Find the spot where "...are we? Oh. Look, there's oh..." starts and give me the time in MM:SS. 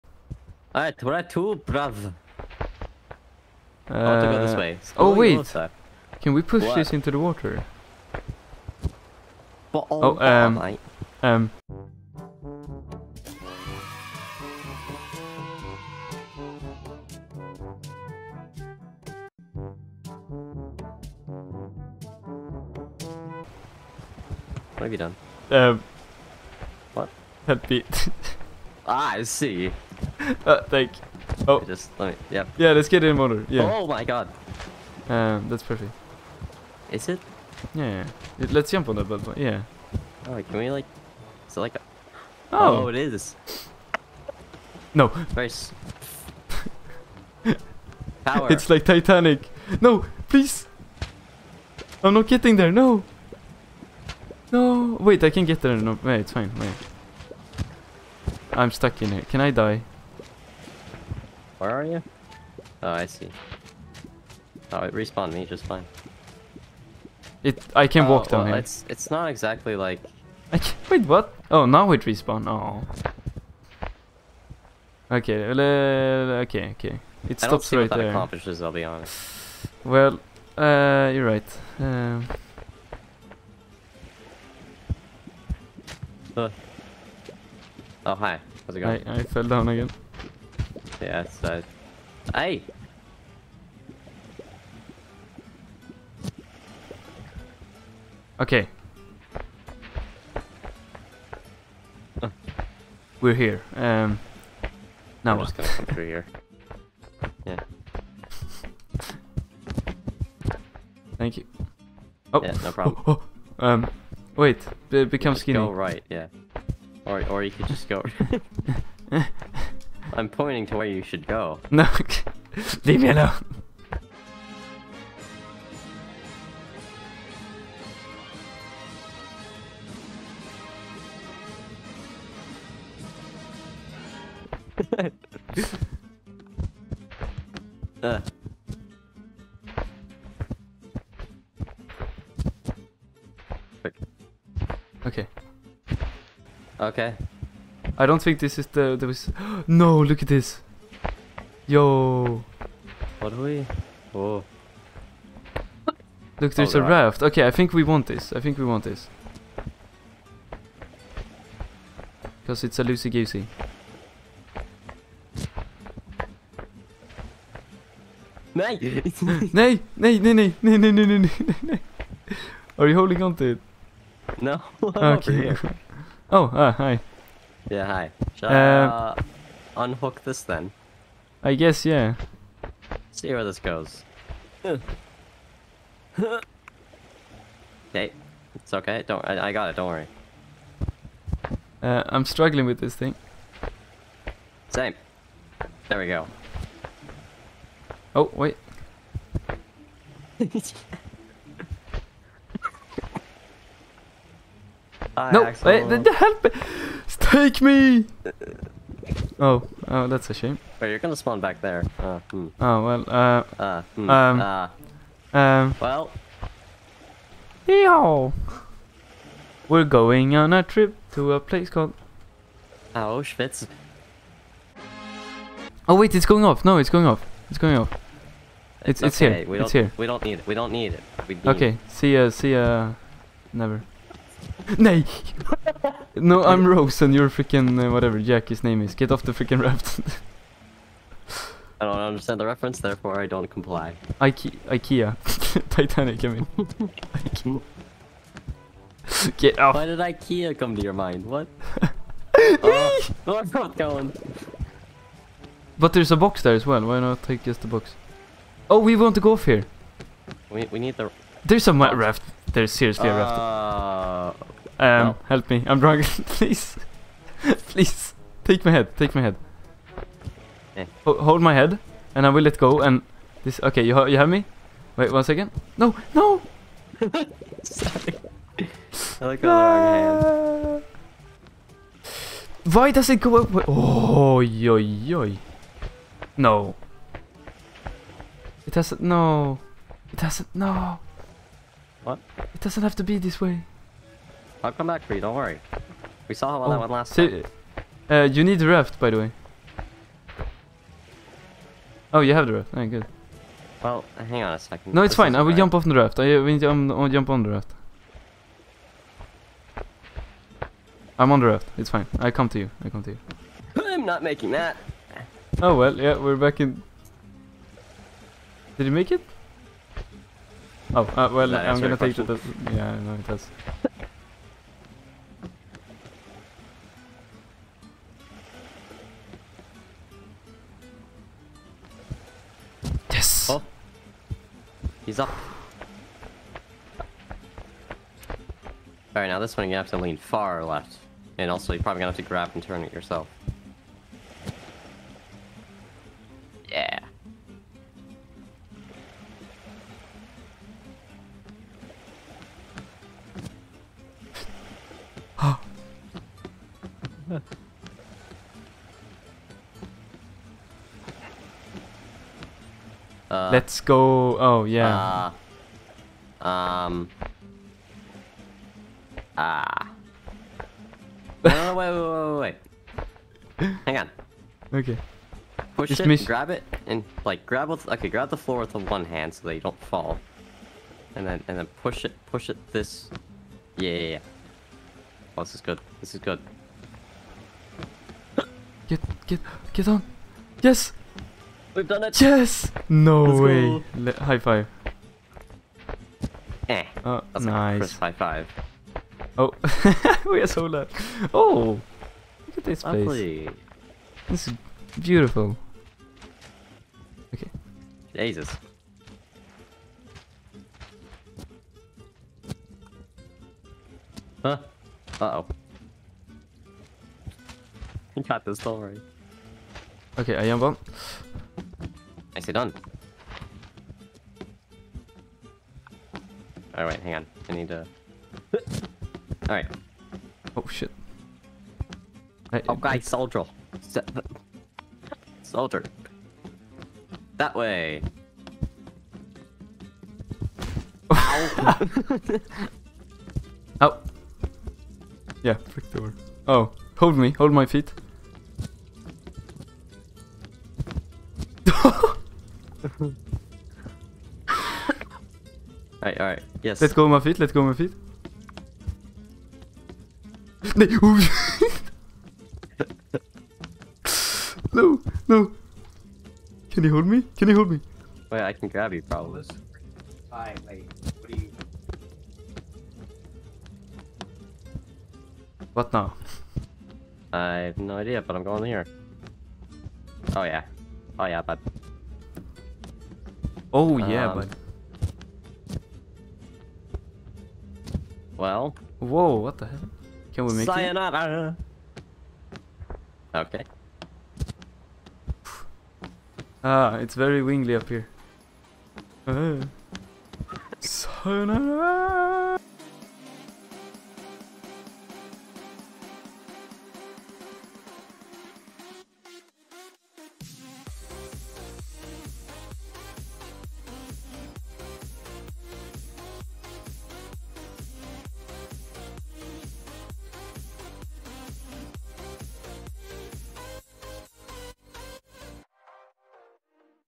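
02:33.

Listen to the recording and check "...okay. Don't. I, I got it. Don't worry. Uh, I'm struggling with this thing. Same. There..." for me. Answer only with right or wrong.
right.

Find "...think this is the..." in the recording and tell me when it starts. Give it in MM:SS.
02:28.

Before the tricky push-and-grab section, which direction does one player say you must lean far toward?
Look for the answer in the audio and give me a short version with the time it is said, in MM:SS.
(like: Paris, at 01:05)
Left, at 05:40.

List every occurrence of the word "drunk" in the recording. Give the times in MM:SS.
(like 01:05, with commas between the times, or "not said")
04:25.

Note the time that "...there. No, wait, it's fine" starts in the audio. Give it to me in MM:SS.
00:55.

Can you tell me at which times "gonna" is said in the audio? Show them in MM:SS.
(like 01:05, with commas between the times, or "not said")
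03:30, 05:21, 05:42.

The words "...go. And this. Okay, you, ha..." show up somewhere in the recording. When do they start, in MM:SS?
04:32.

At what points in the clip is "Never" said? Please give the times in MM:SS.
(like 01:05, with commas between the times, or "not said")
03:53.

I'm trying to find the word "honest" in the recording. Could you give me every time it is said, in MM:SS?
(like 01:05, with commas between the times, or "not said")
01:18.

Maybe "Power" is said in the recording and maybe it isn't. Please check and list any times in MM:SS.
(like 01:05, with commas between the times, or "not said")
00:48.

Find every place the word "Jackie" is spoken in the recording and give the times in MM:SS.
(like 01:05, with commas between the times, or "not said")
03:58.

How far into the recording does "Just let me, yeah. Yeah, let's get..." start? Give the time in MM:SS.
00:31.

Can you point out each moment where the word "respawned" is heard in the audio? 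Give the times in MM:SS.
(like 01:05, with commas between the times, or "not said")
01:04, 01:12.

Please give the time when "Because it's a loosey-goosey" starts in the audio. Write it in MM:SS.
02:42.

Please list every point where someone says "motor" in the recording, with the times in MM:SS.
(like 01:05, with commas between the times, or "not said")
00:33.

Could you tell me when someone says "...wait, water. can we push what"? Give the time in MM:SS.
00:05.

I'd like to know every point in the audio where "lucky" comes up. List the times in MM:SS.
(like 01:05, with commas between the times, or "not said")
06:40.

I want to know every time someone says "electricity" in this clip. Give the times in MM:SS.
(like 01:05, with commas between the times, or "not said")
not said.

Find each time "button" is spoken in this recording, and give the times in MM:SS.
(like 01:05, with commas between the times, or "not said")
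00:39.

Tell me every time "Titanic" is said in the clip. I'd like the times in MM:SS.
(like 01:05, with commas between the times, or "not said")
00:48, 04:05.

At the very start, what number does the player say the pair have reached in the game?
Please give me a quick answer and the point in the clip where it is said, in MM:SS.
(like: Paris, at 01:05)
2, at 00:01.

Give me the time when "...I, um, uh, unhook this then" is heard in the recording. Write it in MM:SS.
02:58.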